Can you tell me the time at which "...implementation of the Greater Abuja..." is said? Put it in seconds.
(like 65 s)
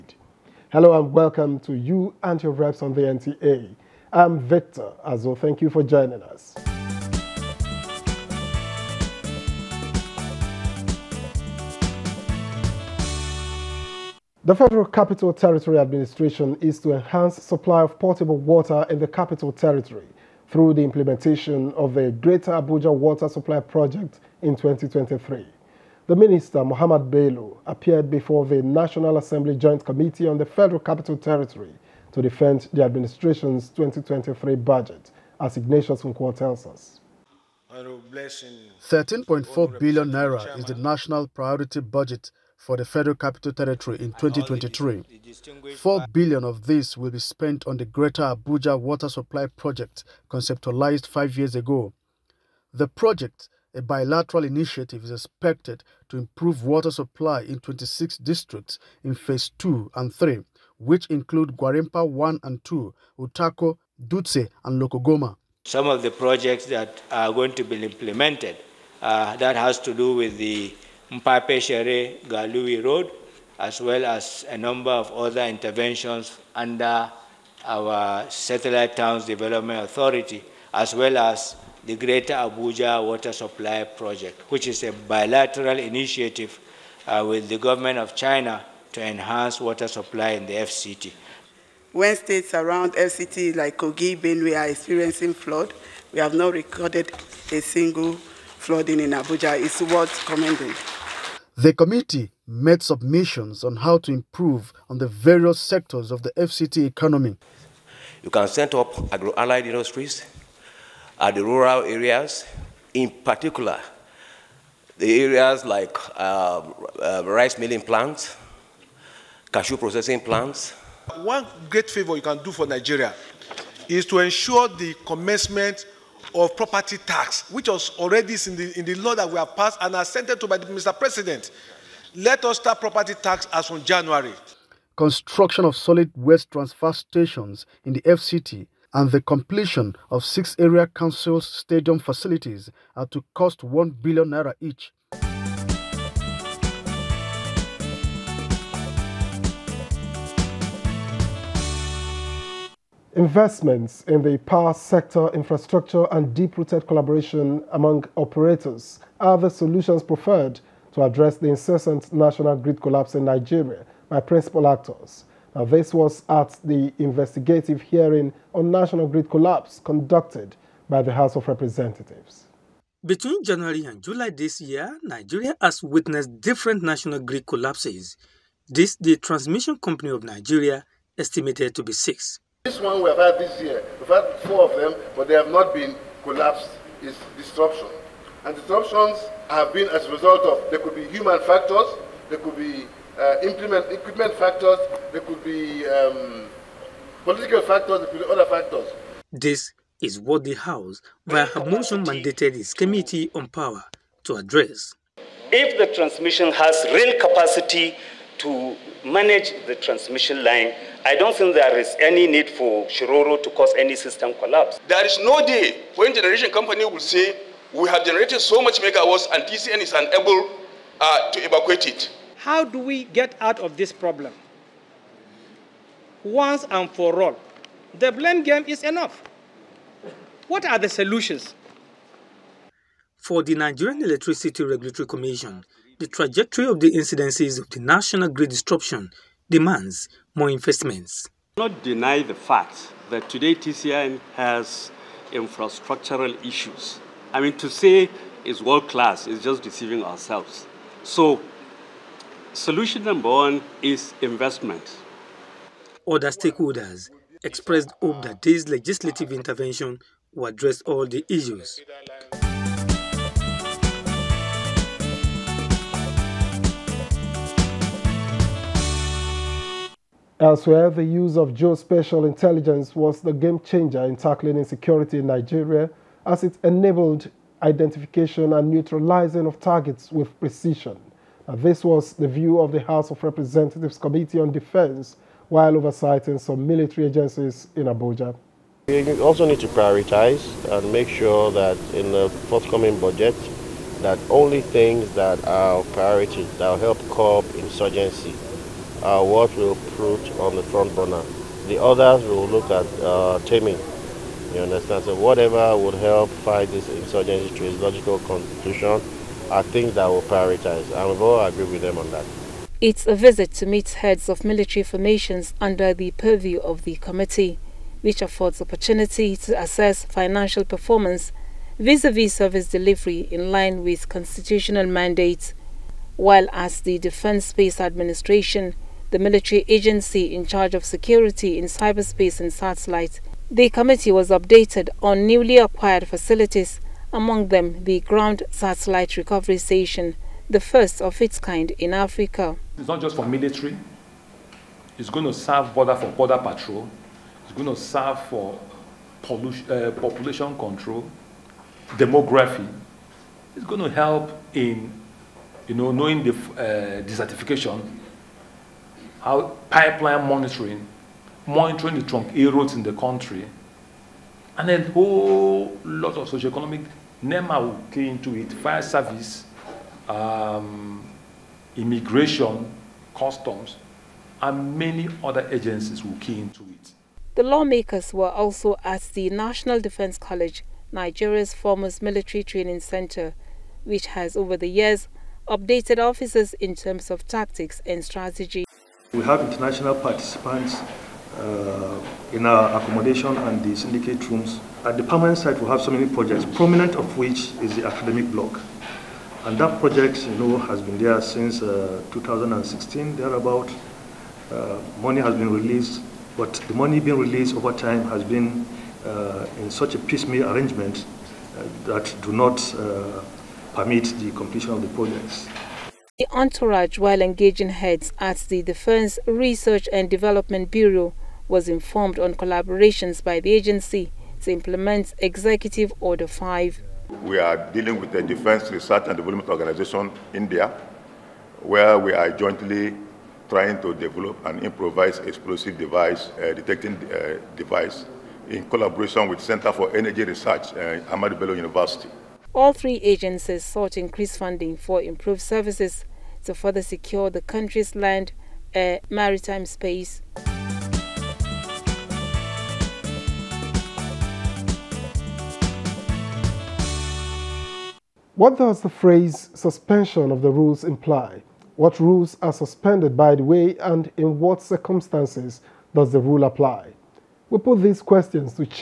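20 s.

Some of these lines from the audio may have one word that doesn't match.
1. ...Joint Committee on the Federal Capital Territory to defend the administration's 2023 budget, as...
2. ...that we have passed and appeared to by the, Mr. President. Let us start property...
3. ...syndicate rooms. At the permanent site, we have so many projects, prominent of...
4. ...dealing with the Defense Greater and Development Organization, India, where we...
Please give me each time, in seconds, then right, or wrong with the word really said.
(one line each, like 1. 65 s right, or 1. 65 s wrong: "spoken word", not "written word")
1. 29 s right
2. 129 s wrong: "assented", not "appeared"
3. 393 s right
4. 427 s wrong: "Research", not "Greater".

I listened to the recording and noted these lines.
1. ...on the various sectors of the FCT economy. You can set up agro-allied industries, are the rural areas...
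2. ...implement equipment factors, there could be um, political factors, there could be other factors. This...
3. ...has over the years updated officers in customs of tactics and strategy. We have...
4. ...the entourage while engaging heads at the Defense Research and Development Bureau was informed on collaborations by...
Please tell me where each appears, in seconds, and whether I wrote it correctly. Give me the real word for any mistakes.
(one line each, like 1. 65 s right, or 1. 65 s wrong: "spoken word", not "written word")
1. 104 s right
2. 193 s right
3. 384 s wrong: "terms", not "customs"
4. 416 s right.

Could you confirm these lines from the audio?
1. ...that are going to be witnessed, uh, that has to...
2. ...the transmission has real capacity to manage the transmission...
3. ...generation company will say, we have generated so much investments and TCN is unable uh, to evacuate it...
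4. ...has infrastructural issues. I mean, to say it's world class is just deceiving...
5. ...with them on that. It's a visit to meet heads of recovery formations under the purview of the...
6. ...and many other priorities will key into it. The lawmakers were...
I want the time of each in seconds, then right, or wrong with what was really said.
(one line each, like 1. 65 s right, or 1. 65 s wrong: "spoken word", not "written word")
1. 66 s wrong: "implemented", not "witnessed"
2. 205 s right
3. 216 s wrong: "megawatts", not "investments"
4. 244 s right
5. 311 s wrong: "military", not "recovery"
6. 374 s wrong: "agencies", not "priorities".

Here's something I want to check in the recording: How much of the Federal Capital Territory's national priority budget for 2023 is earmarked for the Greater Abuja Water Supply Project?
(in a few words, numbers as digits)
4 billion naira.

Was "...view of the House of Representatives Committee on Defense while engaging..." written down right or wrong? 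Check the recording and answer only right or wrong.
wrong.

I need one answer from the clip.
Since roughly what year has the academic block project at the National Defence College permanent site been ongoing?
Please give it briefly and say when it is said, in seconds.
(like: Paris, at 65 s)
2016, at 402 s.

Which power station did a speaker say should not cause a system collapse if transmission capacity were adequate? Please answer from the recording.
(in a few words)
Shiroro.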